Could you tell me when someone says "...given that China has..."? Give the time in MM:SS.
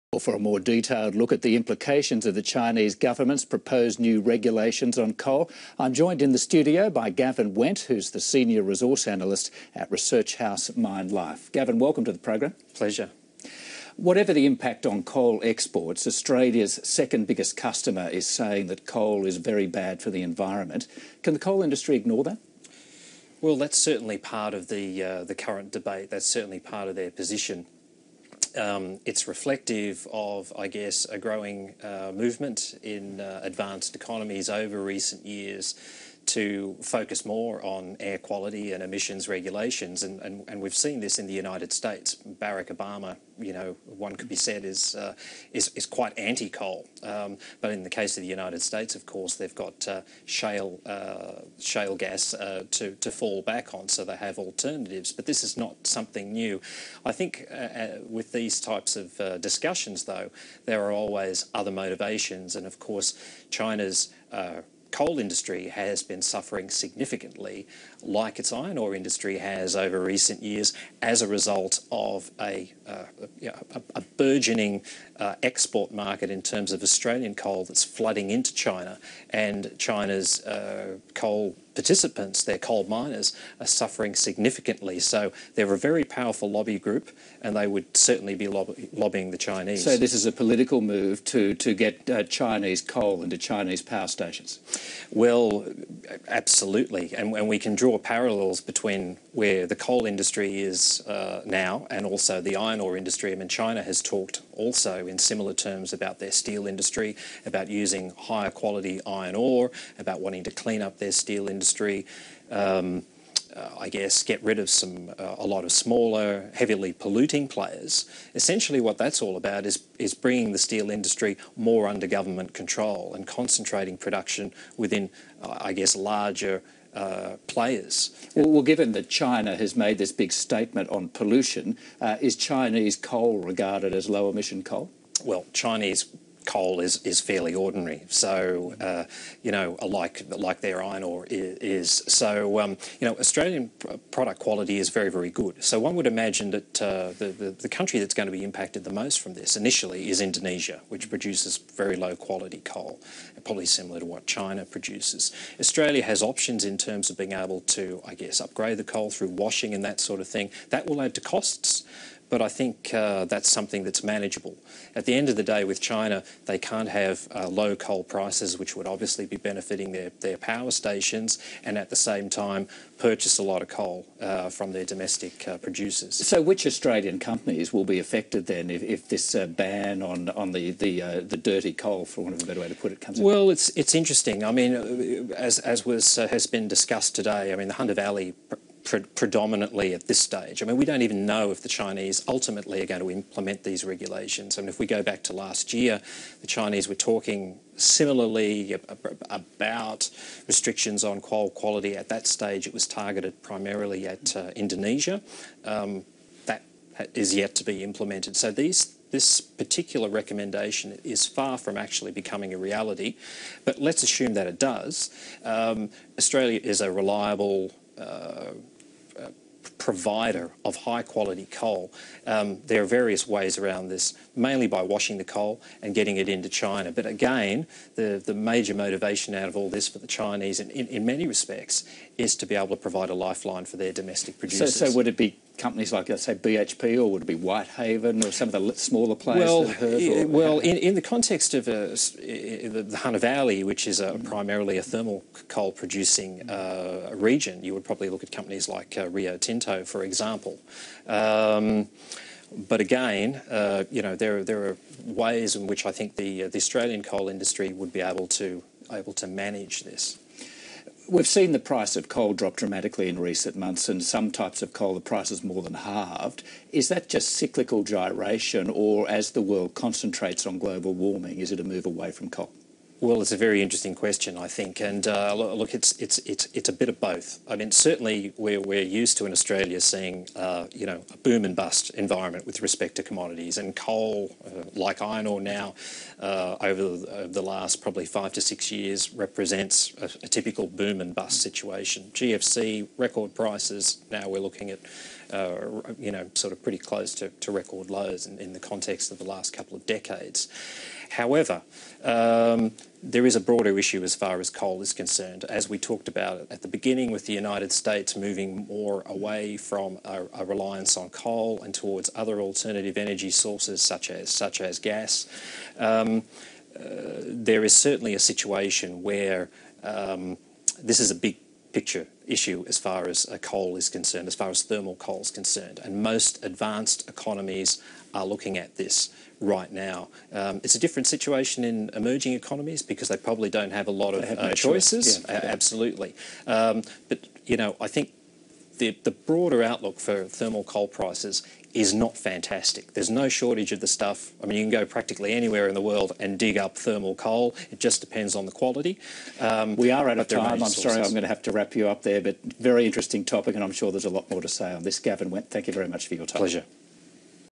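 02:08.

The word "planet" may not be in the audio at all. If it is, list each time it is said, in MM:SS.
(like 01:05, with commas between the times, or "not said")
not said.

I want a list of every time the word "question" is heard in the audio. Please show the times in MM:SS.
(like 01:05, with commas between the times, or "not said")
04:33.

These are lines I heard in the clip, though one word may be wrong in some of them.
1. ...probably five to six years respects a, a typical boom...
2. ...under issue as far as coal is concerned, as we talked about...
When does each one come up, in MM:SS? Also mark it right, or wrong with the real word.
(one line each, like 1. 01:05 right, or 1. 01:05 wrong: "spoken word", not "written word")
1. 04:47 wrong: "represents", not "respects"
2. 05:03 wrong: "broader", not "under".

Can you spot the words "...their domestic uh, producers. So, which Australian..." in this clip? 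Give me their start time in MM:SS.
02:54.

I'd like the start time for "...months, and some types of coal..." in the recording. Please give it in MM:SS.
04:23.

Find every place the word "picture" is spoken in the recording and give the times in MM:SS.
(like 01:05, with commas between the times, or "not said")
05:21.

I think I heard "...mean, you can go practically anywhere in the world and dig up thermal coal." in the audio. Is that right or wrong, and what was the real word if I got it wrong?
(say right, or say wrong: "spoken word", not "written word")
right.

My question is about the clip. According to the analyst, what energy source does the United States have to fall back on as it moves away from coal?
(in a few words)
shale gas.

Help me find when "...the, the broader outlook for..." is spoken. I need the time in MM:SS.
05:38.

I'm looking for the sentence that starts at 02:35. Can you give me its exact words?
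Australia has options in terms of being able to, I guess, upgrade the coal through washing and that sort of thing.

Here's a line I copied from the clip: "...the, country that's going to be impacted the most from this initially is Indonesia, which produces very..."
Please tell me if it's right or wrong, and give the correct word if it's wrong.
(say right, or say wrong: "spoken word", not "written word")
right.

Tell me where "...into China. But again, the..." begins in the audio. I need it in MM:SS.
03:46.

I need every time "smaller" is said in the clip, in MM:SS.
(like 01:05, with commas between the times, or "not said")
01:55, 03:58.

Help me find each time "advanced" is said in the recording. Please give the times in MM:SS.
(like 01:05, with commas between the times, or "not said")
00:33, 05:26.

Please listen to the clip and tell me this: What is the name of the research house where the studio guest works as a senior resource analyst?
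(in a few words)
MineLife.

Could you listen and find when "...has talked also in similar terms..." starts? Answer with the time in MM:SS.
01:43.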